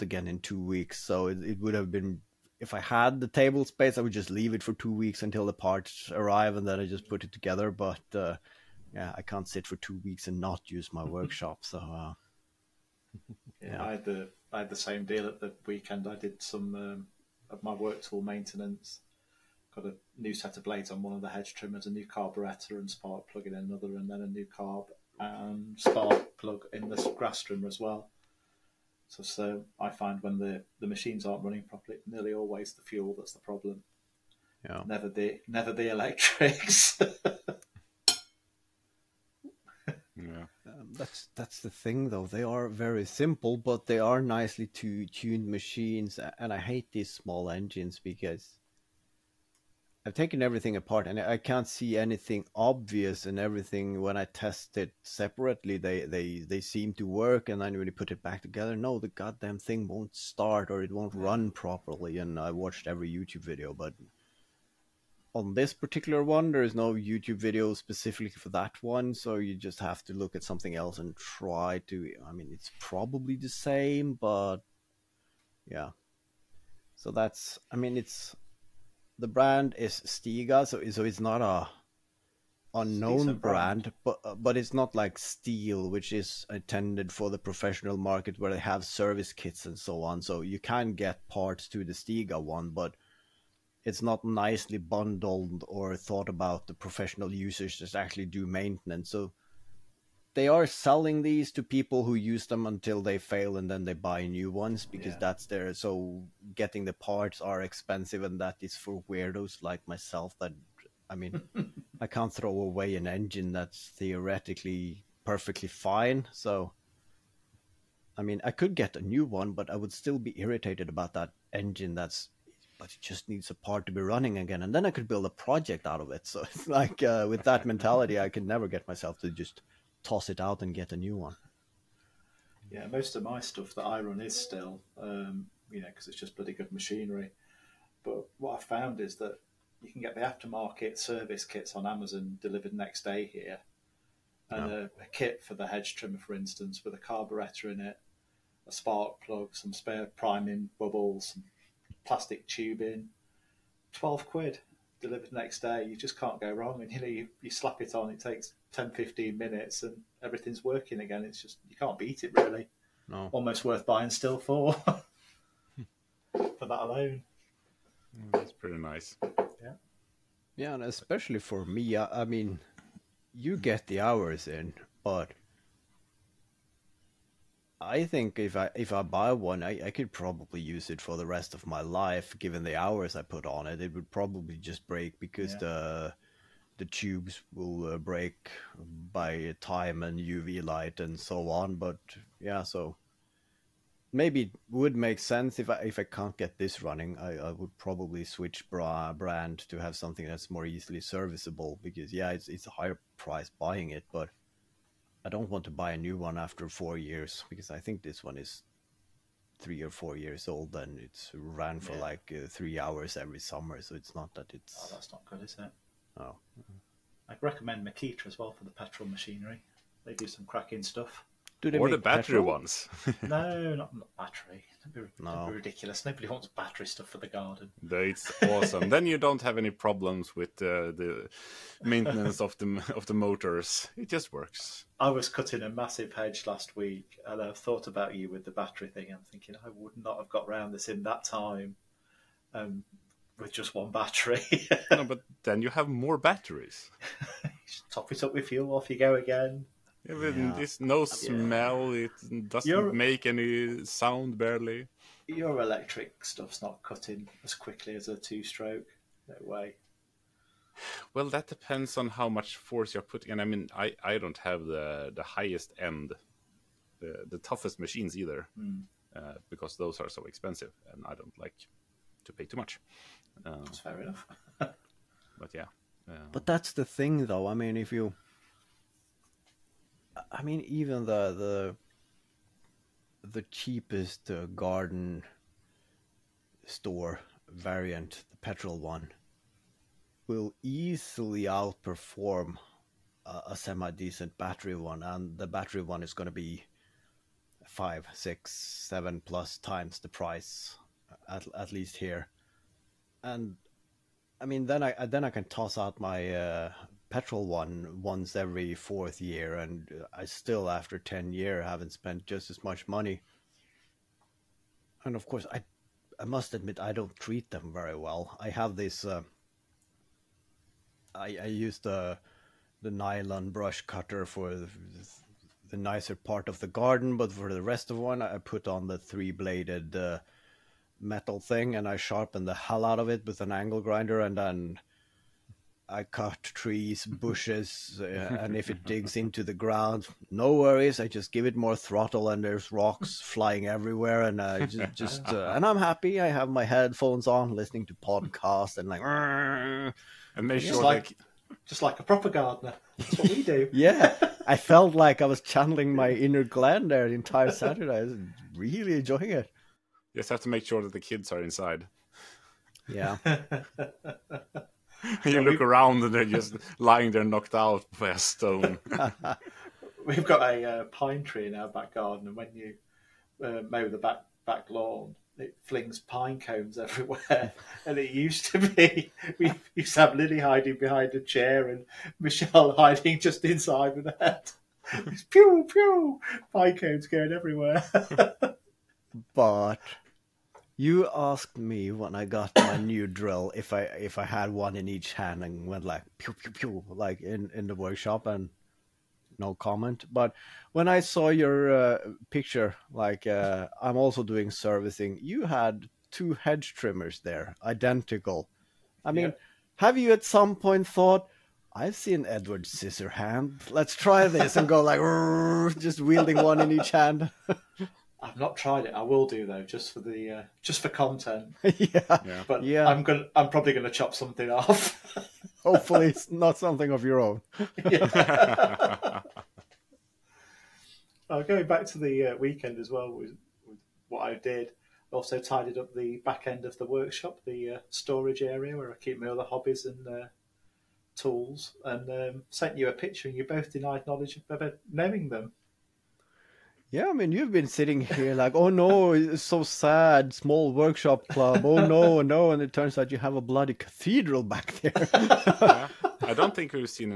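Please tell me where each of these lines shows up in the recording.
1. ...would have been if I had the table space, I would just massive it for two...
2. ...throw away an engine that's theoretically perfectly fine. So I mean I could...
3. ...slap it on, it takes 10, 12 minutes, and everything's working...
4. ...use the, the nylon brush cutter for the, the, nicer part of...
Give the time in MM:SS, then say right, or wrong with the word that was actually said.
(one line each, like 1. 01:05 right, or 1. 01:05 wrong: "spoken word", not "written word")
1. 00:01 wrong: "leave", not "massive"
2. 01:52 right
3. 02:37 wrong: "15", not "12"
4. 05:21 right.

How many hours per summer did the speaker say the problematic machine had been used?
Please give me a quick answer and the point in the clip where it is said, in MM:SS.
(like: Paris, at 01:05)
3 hours, at 03:32.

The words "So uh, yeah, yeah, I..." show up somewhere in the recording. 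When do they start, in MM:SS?
00:11.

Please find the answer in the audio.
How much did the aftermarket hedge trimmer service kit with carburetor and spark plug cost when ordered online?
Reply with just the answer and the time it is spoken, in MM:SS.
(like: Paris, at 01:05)
12 quid, at 02:33.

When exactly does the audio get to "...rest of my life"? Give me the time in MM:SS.
03:01.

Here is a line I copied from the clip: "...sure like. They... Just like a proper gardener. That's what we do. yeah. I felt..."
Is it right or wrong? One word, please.
right.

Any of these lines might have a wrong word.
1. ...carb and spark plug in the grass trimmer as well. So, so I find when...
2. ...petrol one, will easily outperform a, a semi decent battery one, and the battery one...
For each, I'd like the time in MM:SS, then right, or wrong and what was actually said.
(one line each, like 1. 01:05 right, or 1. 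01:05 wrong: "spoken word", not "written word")
1. 00:24 right
2. 04:48 right.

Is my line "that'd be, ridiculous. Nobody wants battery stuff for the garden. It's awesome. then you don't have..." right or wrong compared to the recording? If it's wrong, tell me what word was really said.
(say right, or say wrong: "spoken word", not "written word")
right.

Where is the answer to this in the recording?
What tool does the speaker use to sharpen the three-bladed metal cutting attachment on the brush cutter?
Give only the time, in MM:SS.
05:33.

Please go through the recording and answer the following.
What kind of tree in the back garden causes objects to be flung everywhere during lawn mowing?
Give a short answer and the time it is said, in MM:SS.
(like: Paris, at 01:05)
pine tree, at 06:10.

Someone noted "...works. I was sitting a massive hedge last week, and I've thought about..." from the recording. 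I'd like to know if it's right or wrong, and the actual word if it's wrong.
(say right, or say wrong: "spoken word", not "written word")
wrong: "cutting", not "sitting".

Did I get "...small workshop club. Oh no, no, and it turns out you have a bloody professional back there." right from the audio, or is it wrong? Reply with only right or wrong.
wrong.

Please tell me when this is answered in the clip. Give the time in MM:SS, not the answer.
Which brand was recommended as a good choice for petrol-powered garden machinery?
03:37.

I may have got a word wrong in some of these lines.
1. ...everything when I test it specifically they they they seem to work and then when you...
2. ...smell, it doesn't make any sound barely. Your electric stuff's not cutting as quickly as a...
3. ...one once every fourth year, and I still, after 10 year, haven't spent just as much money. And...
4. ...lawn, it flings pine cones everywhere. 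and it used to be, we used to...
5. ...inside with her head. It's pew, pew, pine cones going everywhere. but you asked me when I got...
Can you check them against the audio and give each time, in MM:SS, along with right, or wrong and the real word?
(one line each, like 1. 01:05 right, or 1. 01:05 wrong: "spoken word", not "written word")
1. 00:53 wrong: "separately", not "specifically"
2. 04:11 right
3. 05:07 right
4. 06:14 right
5. 06:23 right.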